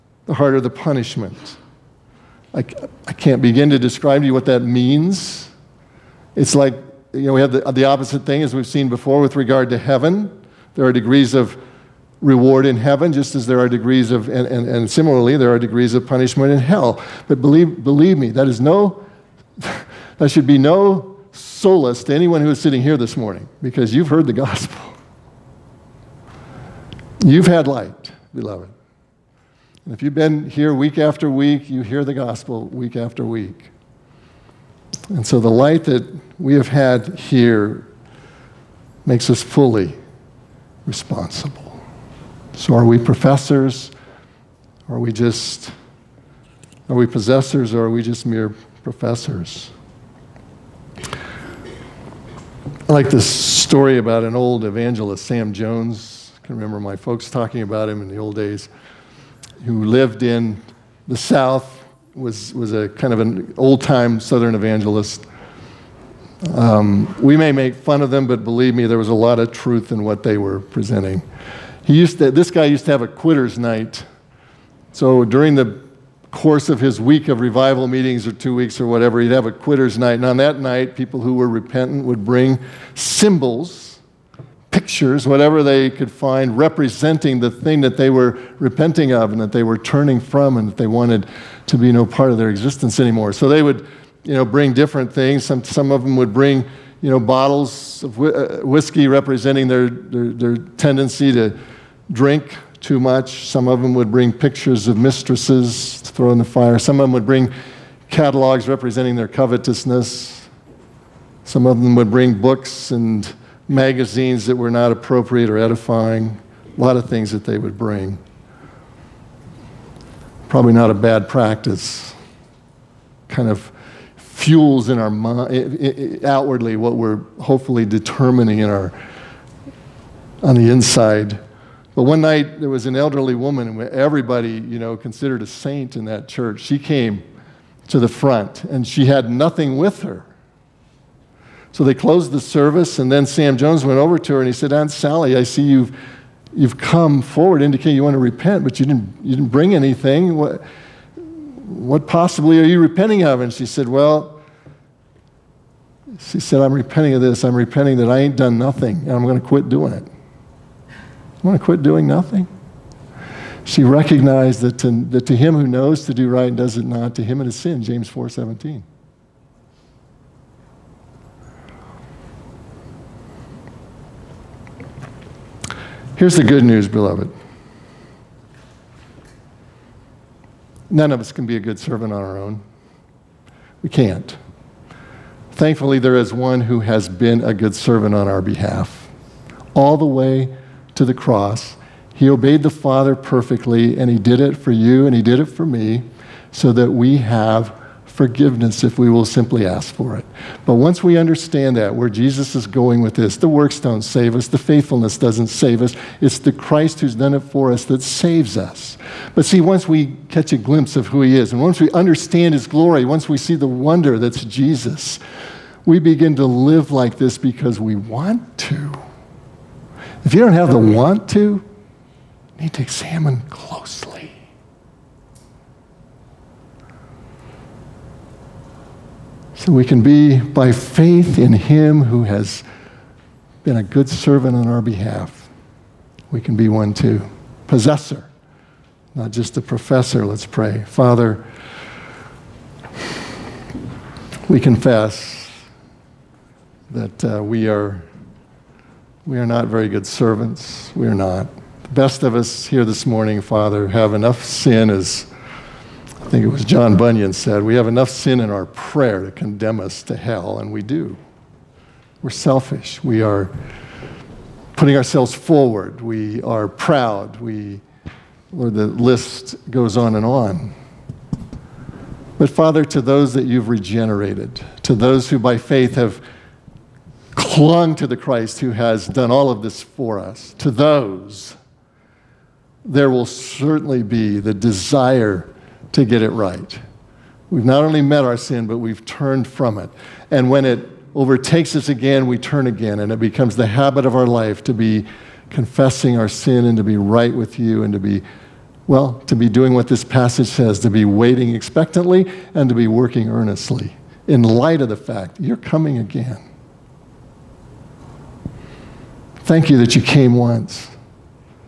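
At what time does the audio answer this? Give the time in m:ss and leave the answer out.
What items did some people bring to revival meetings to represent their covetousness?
1:48.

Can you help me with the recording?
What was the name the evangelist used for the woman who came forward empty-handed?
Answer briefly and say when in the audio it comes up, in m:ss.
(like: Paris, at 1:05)
Aunt Sally, at 2:24.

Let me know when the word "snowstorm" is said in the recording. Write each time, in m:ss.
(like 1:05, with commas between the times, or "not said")
not said.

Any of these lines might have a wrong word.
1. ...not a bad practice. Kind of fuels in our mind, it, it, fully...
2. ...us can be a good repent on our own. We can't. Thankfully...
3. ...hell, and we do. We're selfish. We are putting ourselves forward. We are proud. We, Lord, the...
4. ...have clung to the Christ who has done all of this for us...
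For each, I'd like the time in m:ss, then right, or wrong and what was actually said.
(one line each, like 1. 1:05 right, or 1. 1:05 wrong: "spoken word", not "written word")
1. 2:00 wrong: "outwardly", not "fully"
2. 3:01 wrong: "servant", not "repent"
3. 4:20 right
4. 4:35 right.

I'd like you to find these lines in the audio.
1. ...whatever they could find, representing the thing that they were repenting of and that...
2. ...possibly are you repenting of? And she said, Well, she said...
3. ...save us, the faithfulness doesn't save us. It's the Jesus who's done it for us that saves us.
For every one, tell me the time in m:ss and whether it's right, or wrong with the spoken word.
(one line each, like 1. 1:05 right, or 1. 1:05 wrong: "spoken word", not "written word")
1. 1:25 right
2. 2:32 right
3. 3:24 wrong: "Christ", not "Jesus".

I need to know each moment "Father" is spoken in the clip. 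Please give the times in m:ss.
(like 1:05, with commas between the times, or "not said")
3:12, 4:00, 4:13, 4:32.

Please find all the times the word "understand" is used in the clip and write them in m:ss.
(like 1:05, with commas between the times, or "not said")
3:21, 3:31.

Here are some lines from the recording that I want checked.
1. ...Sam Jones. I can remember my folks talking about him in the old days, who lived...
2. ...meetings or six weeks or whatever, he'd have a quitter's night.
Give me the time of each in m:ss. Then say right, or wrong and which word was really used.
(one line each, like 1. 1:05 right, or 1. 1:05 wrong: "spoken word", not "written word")
1. 0:55 right
2. 1:17 wrong: "two", not "six".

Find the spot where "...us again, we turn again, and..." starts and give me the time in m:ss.
4:51.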